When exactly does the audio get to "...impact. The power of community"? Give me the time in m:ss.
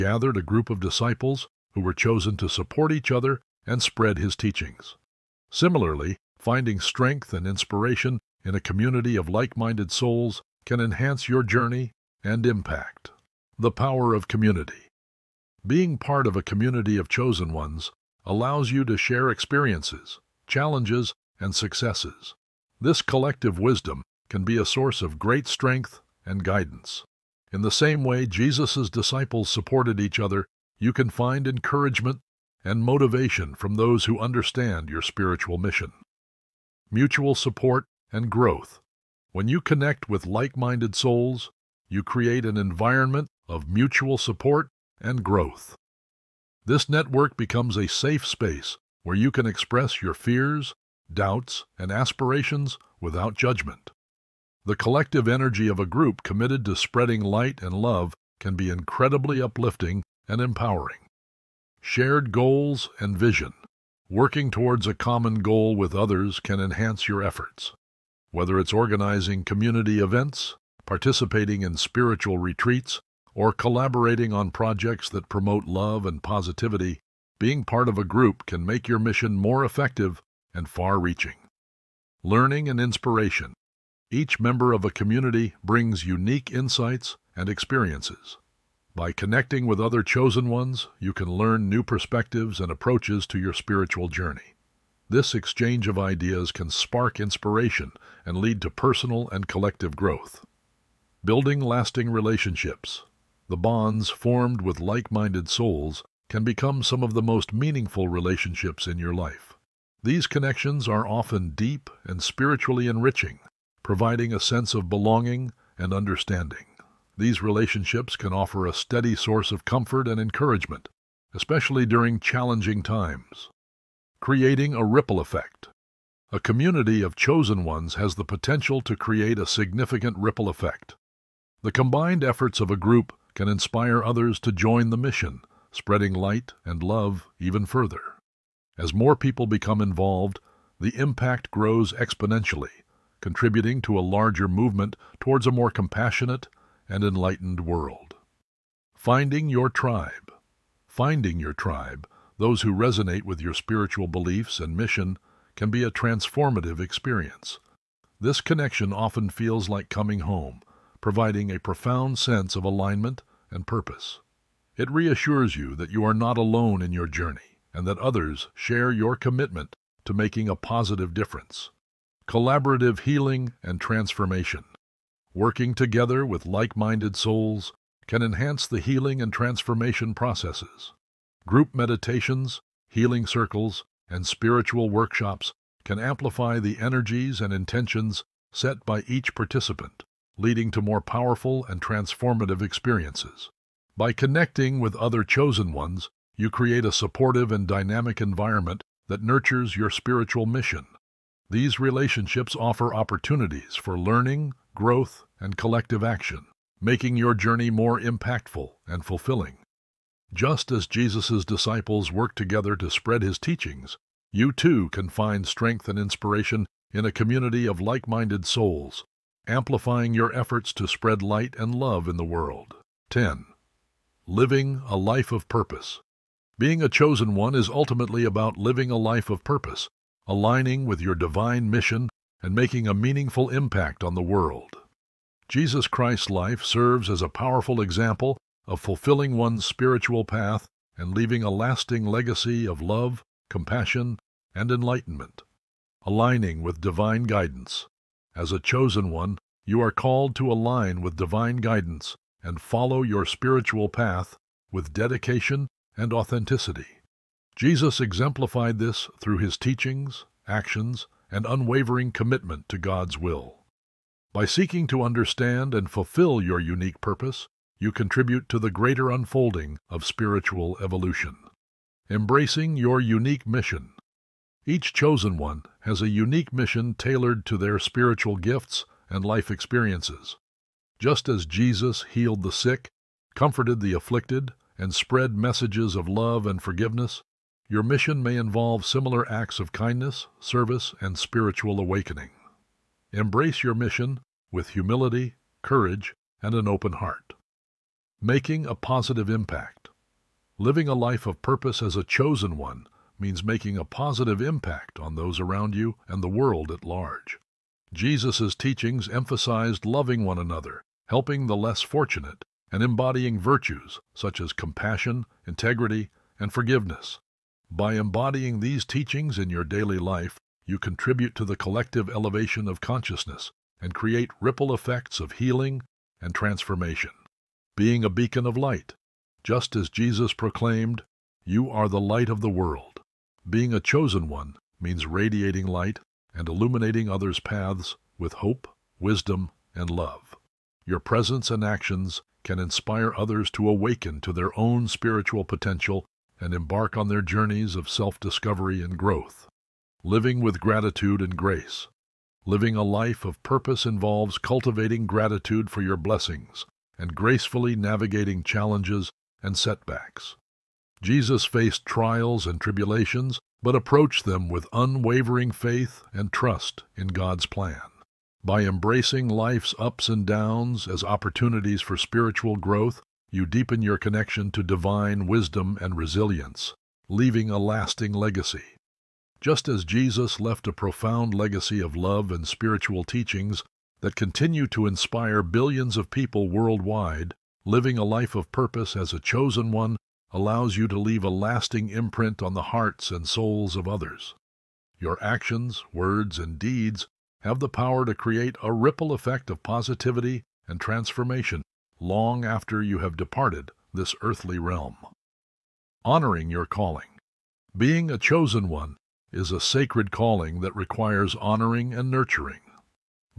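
0:12.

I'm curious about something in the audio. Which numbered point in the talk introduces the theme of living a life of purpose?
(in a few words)
10.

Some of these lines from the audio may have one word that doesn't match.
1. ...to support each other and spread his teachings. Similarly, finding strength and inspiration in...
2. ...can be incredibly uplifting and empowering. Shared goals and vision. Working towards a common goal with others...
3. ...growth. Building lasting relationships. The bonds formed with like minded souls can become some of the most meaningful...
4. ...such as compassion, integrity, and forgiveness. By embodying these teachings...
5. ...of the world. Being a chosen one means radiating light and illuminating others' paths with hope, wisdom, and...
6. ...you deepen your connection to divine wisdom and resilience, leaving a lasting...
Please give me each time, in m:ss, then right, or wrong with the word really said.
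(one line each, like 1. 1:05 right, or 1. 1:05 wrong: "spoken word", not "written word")
1. 0:02 right
2. 0:58 right
3. 1:39 right
4. 5:14 right
5. 5:32 right
6. 6:13 right.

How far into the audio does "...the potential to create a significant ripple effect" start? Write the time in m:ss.
2:08.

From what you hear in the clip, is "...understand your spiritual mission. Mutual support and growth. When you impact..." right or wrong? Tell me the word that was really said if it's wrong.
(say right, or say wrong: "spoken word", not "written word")
wrong: "connect", not "impact".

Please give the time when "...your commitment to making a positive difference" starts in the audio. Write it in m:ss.
2:48.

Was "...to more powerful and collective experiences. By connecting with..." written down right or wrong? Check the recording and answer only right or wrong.
wrong.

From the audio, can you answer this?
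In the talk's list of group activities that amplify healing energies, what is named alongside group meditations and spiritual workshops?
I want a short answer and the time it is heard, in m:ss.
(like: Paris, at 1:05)
Healing circles, at 3:02.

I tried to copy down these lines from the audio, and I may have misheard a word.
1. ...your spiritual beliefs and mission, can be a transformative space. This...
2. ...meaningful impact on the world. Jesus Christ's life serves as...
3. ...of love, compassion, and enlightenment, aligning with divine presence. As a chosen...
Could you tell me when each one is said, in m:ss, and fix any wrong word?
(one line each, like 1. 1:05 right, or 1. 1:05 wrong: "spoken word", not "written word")
1. 2:33 wrong: "experience", not "space"
2. 3:52 right
3. 4:02 wrong: "guidance", not "presence".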